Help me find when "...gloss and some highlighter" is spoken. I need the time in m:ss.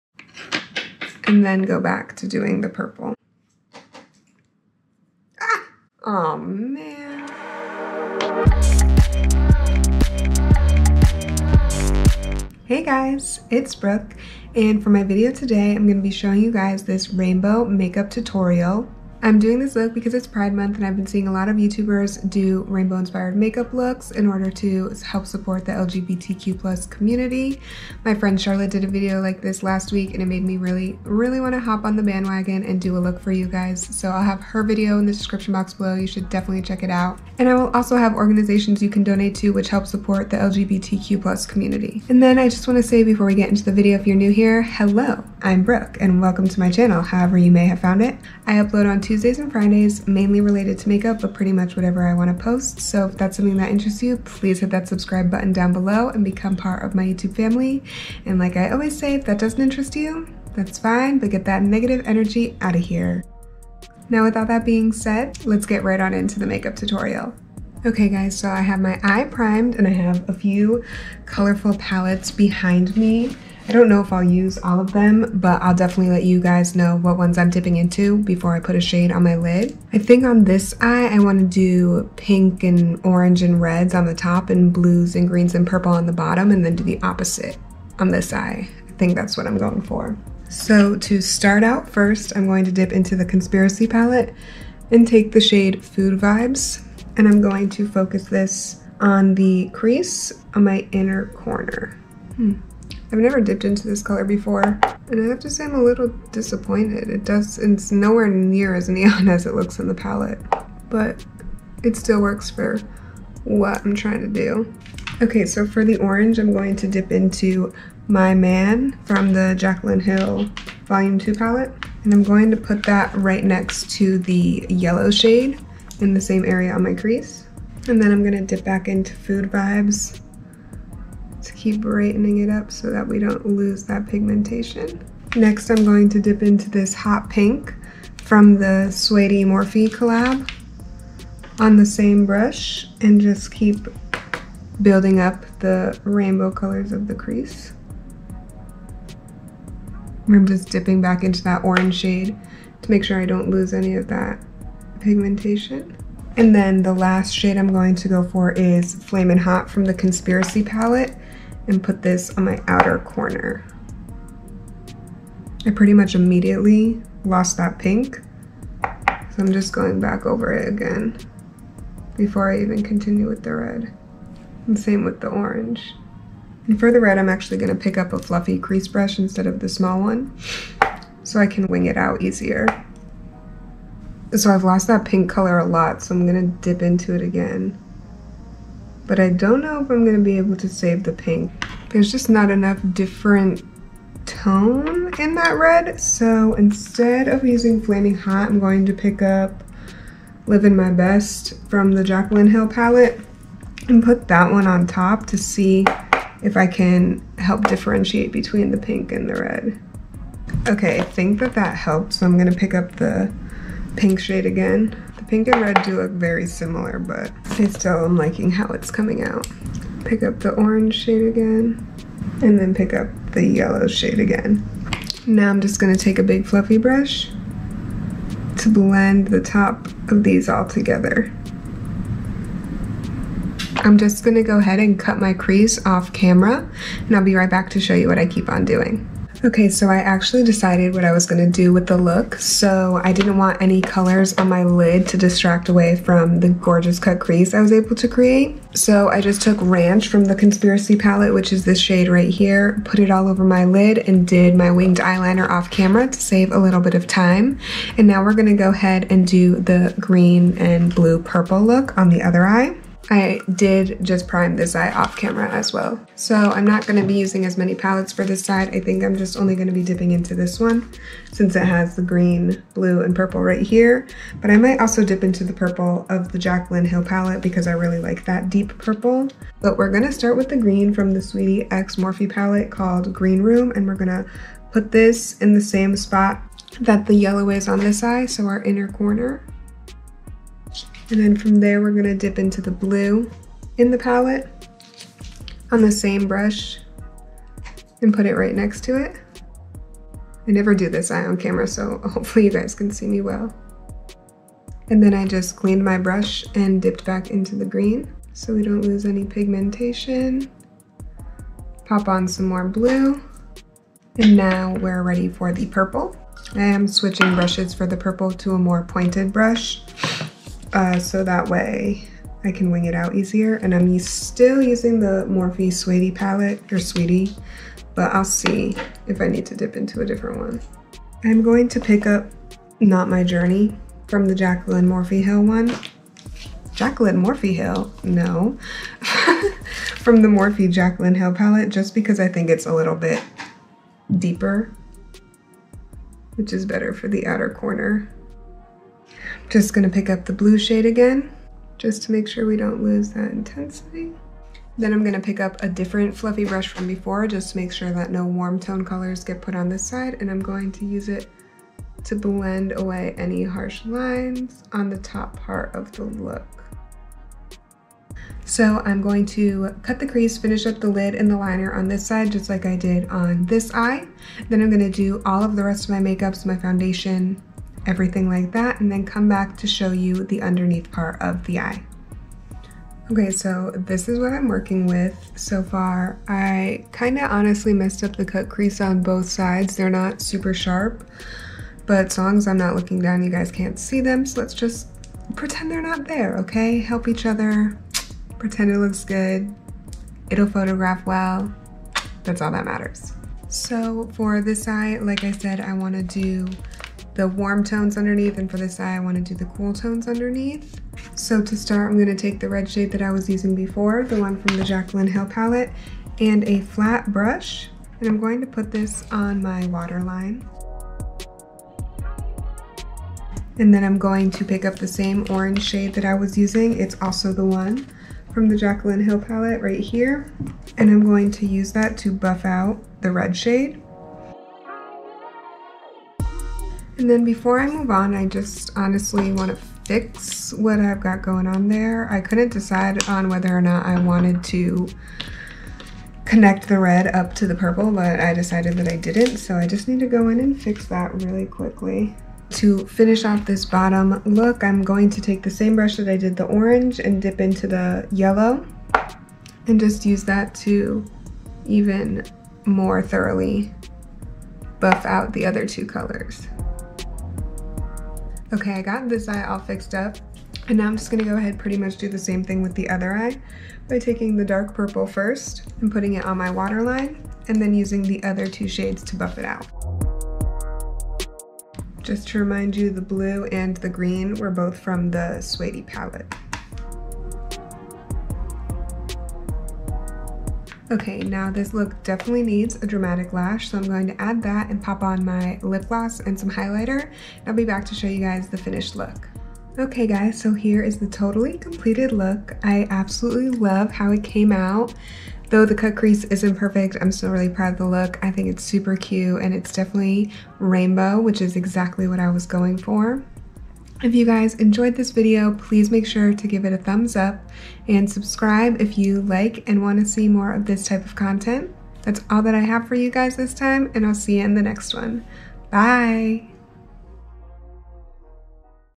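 8:15.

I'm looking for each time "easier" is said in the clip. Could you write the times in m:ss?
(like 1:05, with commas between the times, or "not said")
3:02, 5:23.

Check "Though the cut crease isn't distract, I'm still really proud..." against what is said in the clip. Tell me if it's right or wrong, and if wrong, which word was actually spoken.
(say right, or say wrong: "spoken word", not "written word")
wrong: "perfect", not "distract".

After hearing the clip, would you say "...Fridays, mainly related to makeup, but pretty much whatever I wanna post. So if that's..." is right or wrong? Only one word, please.
right.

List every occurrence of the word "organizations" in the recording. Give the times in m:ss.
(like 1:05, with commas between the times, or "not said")
0:38.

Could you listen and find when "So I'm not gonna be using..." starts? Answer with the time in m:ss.
4:26.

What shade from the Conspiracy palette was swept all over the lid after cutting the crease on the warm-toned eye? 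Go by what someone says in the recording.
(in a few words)
Ranch.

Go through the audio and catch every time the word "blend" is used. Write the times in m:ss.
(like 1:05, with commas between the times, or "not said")
3:48, 6:02.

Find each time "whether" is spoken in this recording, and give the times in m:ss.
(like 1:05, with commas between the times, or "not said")
7:23.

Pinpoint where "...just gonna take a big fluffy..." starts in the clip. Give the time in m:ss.
3:45.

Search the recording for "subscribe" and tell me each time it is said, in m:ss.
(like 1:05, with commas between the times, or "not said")
0:54, 8:38.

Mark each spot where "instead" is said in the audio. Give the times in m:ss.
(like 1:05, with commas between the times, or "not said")
2:59, 3:16.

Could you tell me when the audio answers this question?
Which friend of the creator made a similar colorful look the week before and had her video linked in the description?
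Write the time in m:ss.
0:28.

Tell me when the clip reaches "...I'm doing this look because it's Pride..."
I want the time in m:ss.
0:19.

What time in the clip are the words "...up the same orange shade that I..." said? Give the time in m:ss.
7:04.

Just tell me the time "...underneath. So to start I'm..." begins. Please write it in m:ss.
6:50.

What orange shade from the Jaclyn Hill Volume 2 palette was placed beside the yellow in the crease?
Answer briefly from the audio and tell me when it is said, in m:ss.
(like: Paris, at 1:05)
My Man, at 1:58.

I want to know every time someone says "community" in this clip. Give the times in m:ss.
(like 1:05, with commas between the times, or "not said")
0:26, 0:41.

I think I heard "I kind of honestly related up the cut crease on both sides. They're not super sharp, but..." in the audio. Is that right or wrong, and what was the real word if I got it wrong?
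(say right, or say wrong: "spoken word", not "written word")
wrong: "messed", not "related".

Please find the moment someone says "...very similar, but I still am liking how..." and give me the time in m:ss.
3:36.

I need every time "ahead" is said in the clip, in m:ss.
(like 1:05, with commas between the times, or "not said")
3:54, 4:18, 7:51.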